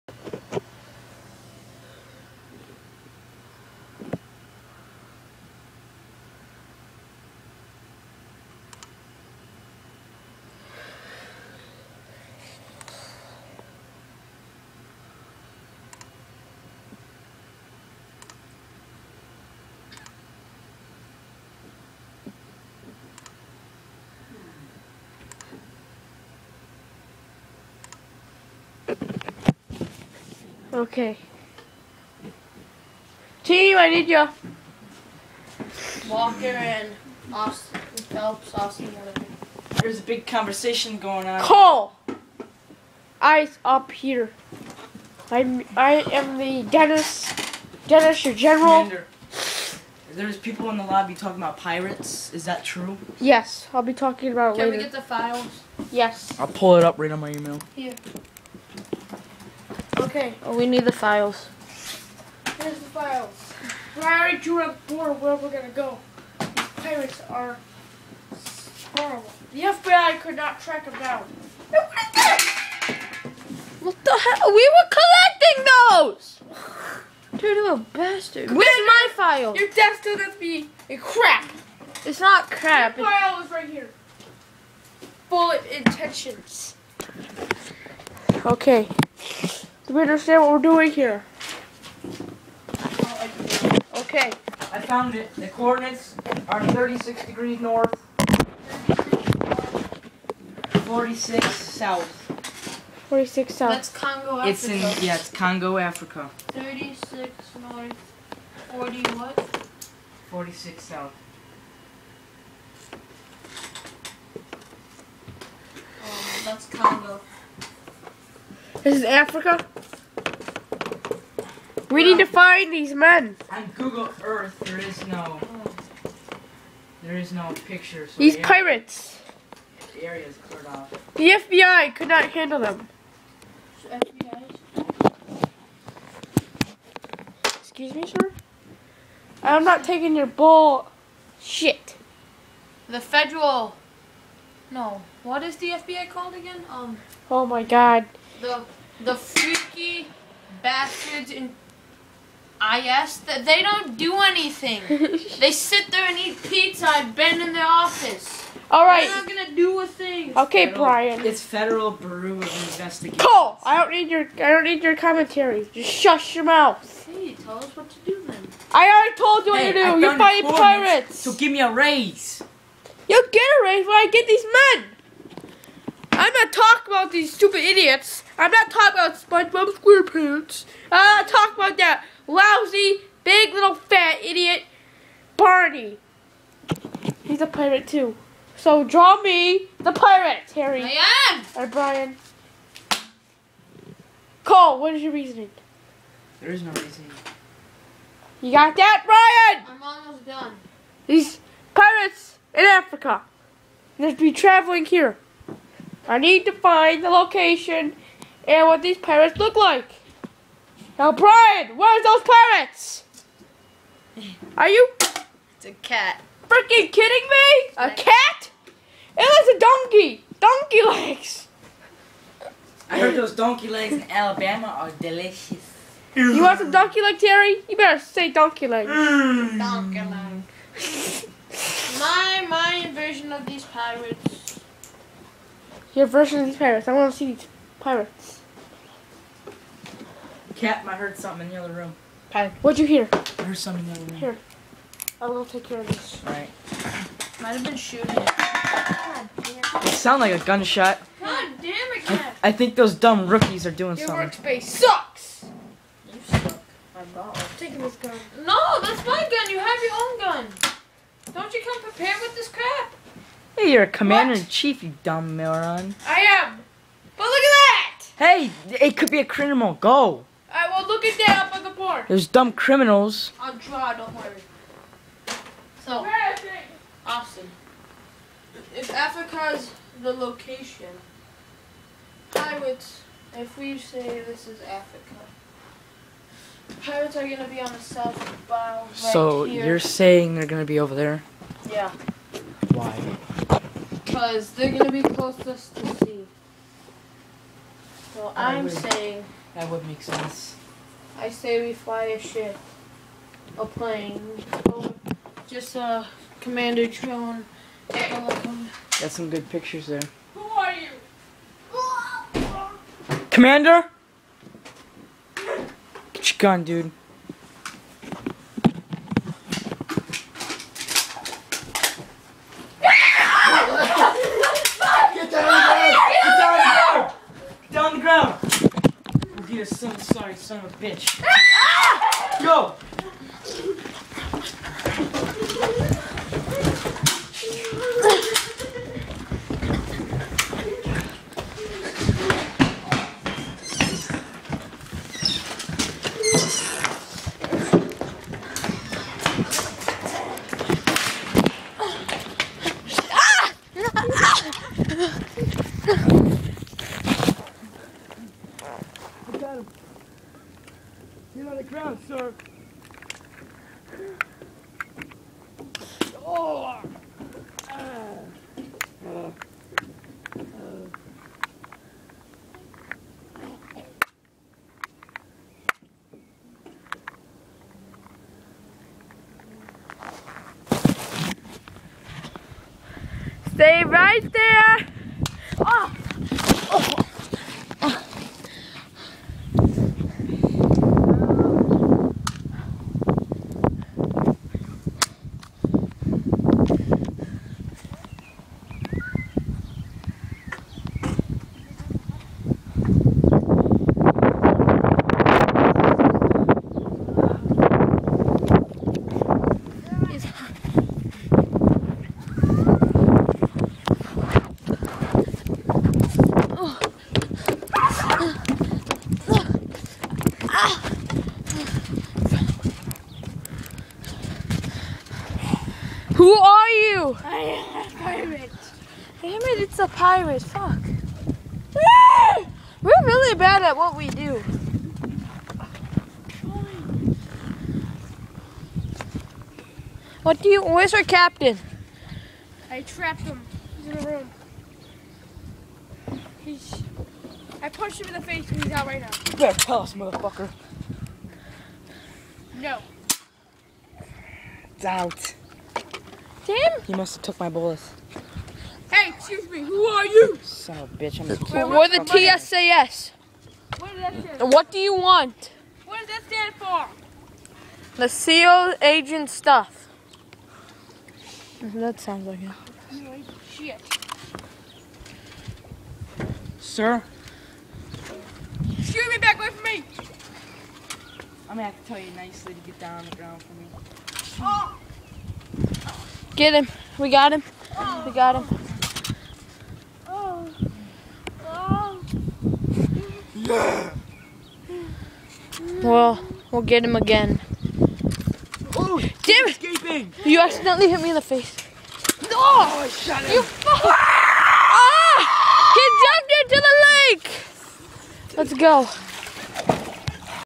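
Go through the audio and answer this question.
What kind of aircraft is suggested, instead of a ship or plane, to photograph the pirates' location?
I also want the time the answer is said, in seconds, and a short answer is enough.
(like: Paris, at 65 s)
Commander drone, at 306 s.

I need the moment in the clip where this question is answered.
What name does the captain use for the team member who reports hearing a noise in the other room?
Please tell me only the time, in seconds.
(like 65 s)
242 s.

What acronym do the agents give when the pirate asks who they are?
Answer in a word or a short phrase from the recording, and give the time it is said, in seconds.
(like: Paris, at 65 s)
TSAS, at 462 s.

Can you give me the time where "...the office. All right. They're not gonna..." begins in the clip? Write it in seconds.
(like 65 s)
157 s.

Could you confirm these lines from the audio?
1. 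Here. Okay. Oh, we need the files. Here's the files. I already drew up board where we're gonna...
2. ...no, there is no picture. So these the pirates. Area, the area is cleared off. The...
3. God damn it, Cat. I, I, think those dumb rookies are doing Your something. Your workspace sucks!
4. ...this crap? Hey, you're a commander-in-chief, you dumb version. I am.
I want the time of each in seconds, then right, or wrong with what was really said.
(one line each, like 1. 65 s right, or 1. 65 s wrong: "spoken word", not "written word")
1. 57 s right
2. 125 s right
3. 251 s right
4. 262 s wrong: "moron", not "version".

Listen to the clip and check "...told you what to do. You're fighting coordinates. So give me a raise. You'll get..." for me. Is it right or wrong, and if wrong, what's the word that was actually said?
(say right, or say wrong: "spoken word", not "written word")
wrong: "pirates", not "coordinates".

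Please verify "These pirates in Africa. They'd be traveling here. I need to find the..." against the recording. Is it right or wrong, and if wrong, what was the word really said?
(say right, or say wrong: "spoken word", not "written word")
right.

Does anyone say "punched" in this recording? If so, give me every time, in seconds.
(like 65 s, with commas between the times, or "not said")
447 s.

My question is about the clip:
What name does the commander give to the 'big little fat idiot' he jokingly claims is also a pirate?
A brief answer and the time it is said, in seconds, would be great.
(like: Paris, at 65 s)
Barney, at 185 s.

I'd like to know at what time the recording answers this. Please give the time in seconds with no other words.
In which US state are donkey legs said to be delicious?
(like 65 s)
224 s.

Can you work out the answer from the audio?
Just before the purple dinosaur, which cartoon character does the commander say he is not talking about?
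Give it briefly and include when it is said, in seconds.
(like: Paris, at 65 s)
SpongeBob SquarePants, at 179 s.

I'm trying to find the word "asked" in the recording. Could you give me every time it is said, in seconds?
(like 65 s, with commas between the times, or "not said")
152 s.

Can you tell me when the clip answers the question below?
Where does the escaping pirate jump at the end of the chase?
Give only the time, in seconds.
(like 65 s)
507 s.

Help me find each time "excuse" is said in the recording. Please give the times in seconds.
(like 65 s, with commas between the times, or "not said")
137 s, 459 s.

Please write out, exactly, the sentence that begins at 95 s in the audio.
The coordinates are 36 degrees north, 46 south.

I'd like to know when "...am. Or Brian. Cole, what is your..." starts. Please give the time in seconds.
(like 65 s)
191 s.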